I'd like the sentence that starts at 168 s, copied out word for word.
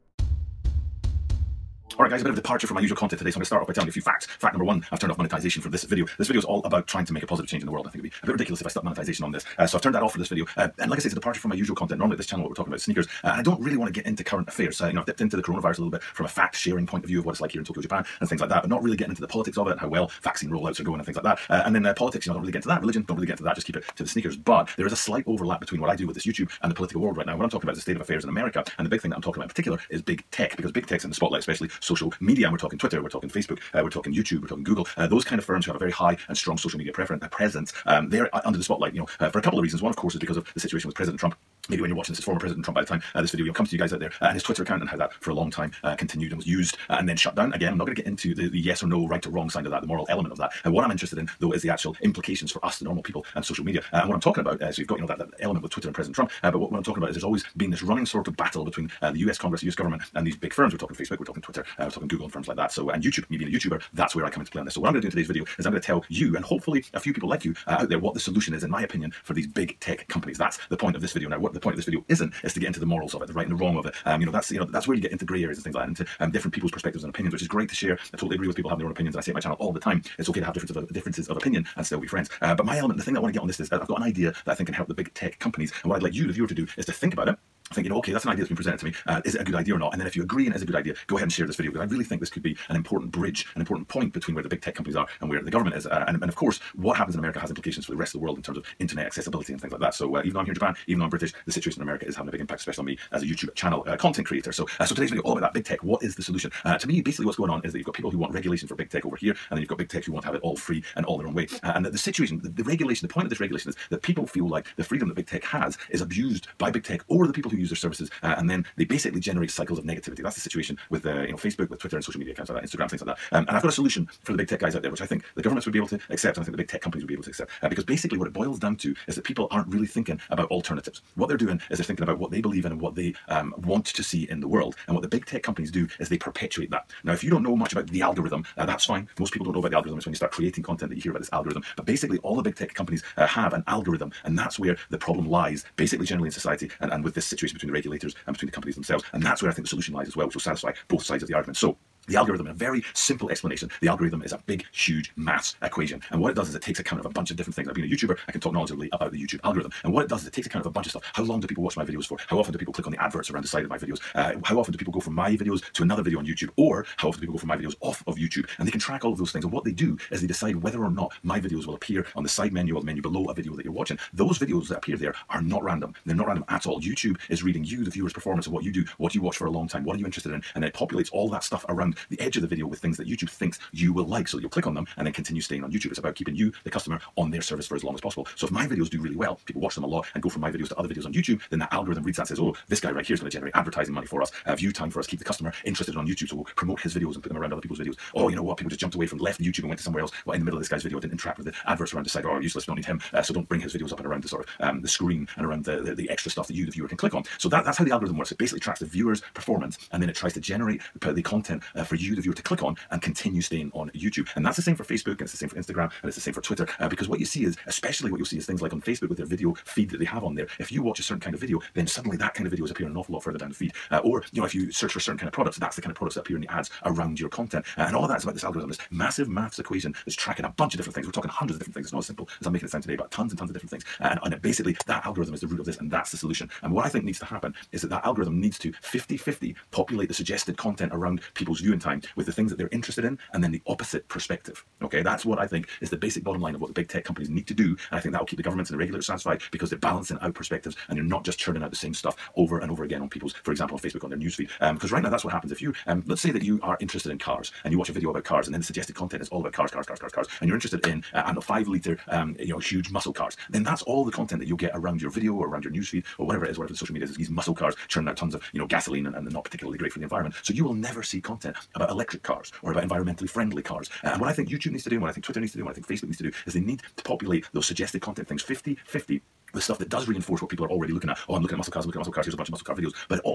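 And they can track all of those things.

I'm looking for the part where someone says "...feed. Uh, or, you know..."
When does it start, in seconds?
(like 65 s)
223 s.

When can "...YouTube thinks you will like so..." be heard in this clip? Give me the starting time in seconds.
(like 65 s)
183 s.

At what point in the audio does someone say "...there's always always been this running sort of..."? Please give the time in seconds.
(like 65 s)
57 s.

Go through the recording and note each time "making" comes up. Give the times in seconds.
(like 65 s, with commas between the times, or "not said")
232 s.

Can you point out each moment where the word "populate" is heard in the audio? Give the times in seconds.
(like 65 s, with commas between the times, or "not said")
180 s, 239 s, 277 s.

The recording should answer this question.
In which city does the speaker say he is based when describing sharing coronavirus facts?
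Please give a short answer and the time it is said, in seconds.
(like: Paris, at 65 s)
Tokyo, at 17 s.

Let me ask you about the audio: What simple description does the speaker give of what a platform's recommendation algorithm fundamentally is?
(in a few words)
a big, huge maths equation.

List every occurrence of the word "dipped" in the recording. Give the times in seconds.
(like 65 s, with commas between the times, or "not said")
15 s.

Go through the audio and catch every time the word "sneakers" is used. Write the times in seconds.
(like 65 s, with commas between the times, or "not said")
12 s, 24 s.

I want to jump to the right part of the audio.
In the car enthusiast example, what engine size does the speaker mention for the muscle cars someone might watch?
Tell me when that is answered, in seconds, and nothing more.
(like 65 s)
261 s.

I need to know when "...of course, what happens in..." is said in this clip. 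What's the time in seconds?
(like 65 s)
96 s.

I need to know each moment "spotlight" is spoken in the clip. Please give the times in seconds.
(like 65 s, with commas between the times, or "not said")
31 s, 38 s.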